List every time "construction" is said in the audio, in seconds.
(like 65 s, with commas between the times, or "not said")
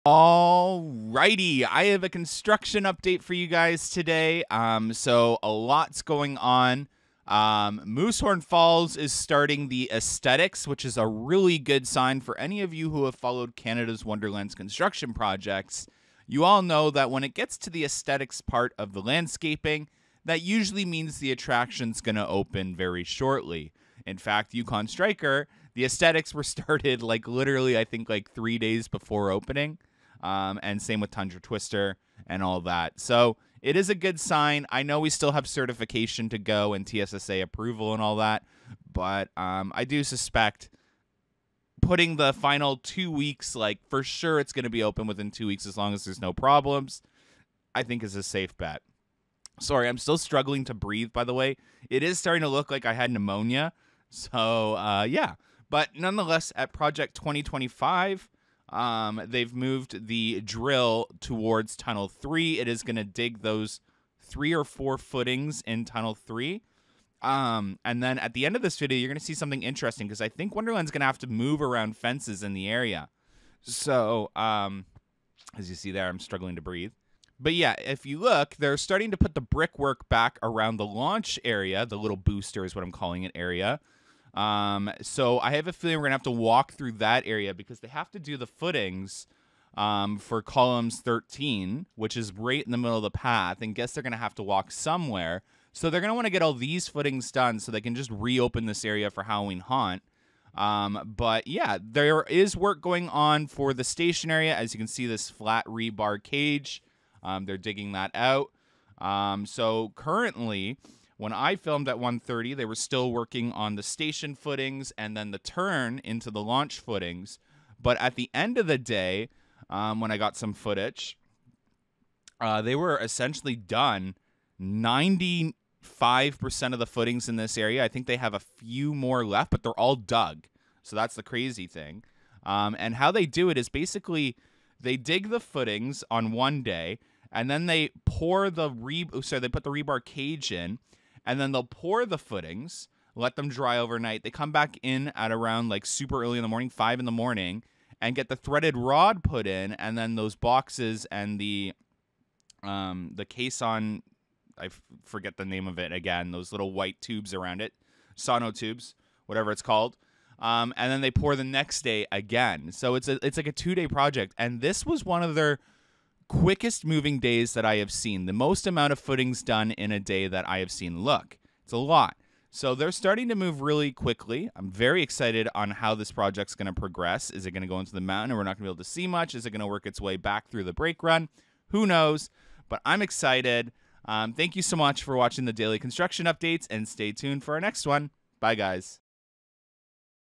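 2 s, 14 s, 185 s.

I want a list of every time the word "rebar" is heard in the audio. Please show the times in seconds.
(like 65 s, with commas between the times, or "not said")
105 s, 139 s.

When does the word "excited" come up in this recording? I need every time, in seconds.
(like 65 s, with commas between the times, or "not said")
175 s, 183 s.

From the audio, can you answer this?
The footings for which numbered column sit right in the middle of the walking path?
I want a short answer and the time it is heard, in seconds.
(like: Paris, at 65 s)
13, at 90 s.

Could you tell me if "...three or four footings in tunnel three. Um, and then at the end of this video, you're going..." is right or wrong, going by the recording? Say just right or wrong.
right.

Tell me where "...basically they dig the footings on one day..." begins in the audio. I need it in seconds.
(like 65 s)
133 s.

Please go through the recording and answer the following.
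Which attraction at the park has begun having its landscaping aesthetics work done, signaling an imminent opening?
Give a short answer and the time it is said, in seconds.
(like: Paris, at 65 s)
Moosehorn Falls, at 7 s.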